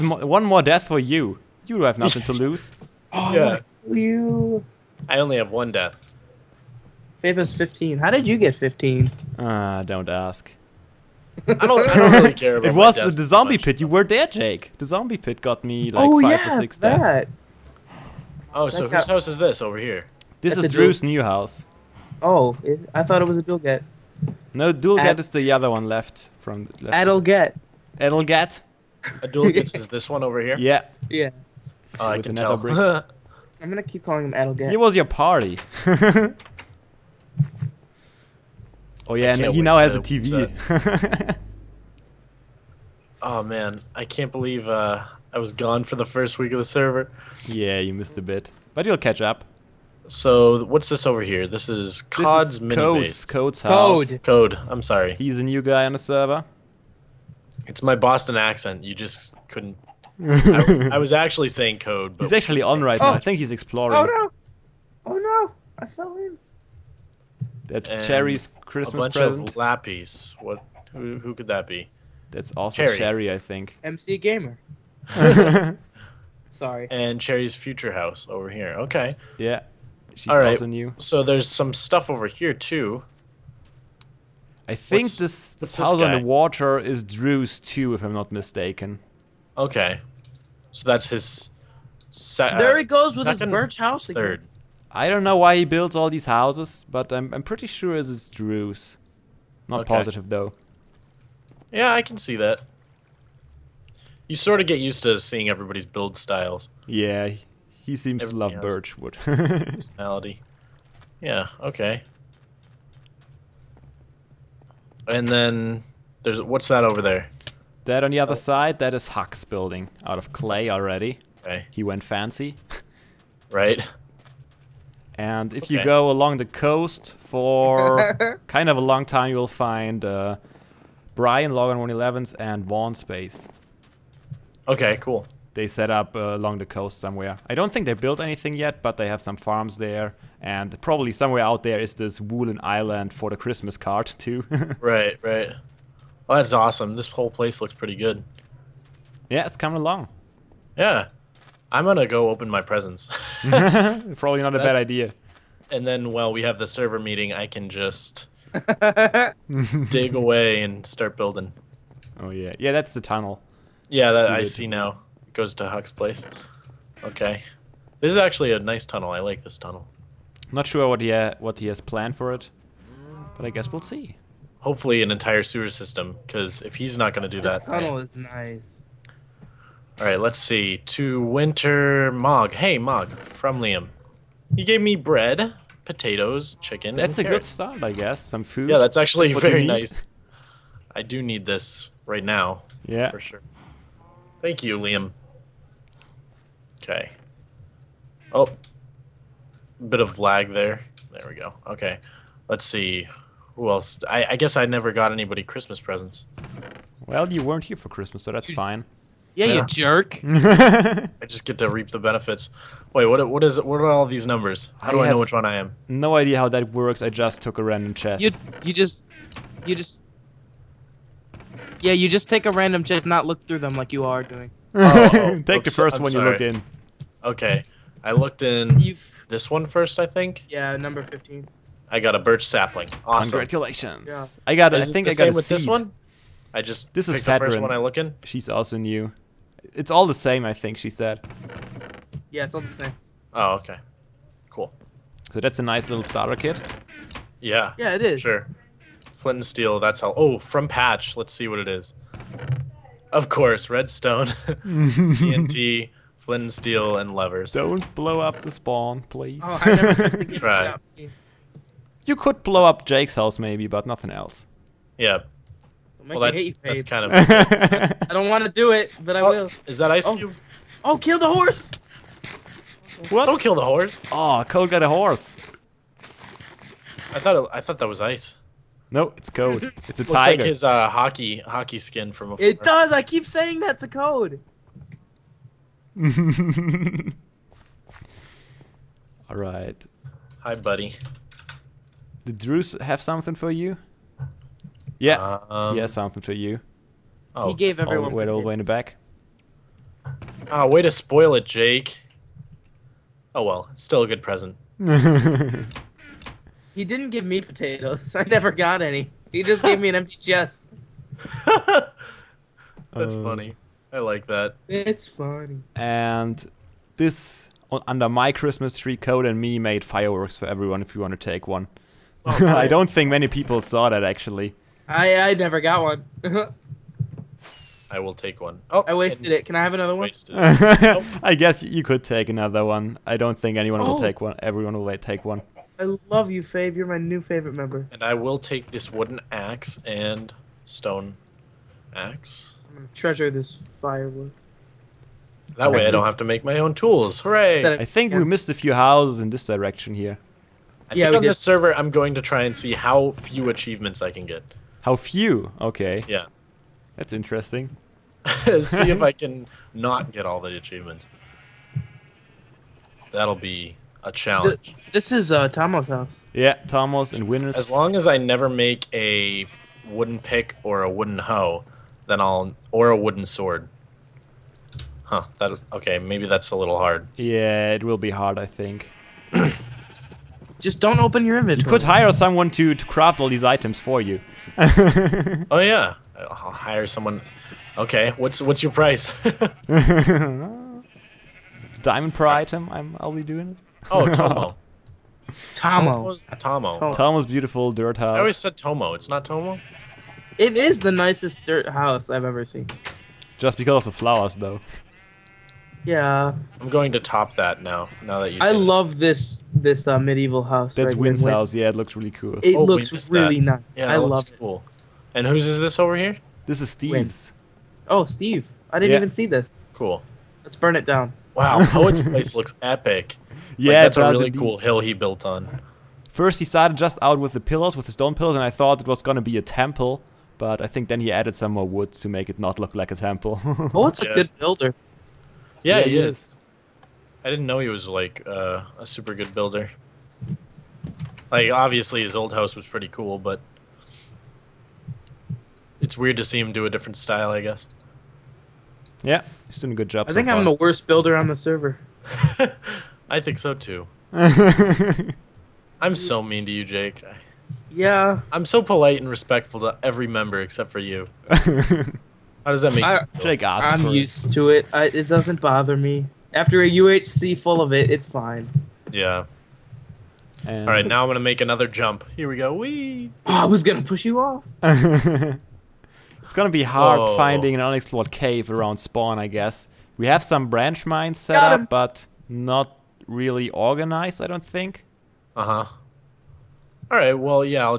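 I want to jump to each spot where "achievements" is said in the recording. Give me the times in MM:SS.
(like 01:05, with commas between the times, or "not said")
05:53, 06:00.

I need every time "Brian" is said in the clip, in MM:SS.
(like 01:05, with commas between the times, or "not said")
02:11.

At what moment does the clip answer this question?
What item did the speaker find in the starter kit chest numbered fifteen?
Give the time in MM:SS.
03:51.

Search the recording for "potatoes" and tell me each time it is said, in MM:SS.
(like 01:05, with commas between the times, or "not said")
03:05, 05:07.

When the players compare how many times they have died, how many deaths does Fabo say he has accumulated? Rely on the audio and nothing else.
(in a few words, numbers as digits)
15.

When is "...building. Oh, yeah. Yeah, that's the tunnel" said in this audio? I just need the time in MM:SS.
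02:41.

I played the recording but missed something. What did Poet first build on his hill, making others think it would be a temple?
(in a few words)
stone pillars.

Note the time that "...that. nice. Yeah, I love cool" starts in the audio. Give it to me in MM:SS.
06:53.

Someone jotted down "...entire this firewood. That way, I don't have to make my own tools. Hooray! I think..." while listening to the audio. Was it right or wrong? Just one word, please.
wrong.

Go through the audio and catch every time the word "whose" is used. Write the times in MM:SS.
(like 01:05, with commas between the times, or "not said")
00:18, 06:55.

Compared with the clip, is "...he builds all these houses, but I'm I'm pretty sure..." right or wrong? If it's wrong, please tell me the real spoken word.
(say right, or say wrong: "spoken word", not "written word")
right.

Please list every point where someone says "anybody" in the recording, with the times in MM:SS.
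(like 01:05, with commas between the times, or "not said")
03:25.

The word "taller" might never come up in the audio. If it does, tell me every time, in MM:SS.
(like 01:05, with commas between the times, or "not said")
not said.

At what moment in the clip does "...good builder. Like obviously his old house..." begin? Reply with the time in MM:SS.
07:19.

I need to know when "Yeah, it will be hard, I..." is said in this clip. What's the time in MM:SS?
06:17.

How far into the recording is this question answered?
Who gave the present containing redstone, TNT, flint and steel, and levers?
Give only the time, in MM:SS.
04:10.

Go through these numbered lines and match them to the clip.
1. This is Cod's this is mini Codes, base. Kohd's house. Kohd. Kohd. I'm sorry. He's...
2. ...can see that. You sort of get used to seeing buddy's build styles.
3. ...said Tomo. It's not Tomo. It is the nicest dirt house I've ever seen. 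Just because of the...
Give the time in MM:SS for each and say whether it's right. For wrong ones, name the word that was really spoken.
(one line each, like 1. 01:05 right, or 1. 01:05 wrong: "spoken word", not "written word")
1. 00:51 right
2. 01:42 wrong: "everybody", not "buddy"
3. 06:38 right.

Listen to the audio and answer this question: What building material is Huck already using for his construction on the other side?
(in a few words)
clay.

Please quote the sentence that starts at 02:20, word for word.
And probably somewhere out there is this woolen island for the Christmas card, too.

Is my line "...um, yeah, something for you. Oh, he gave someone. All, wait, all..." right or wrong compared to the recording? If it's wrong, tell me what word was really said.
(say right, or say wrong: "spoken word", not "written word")
wrong: "everyone", not "someone".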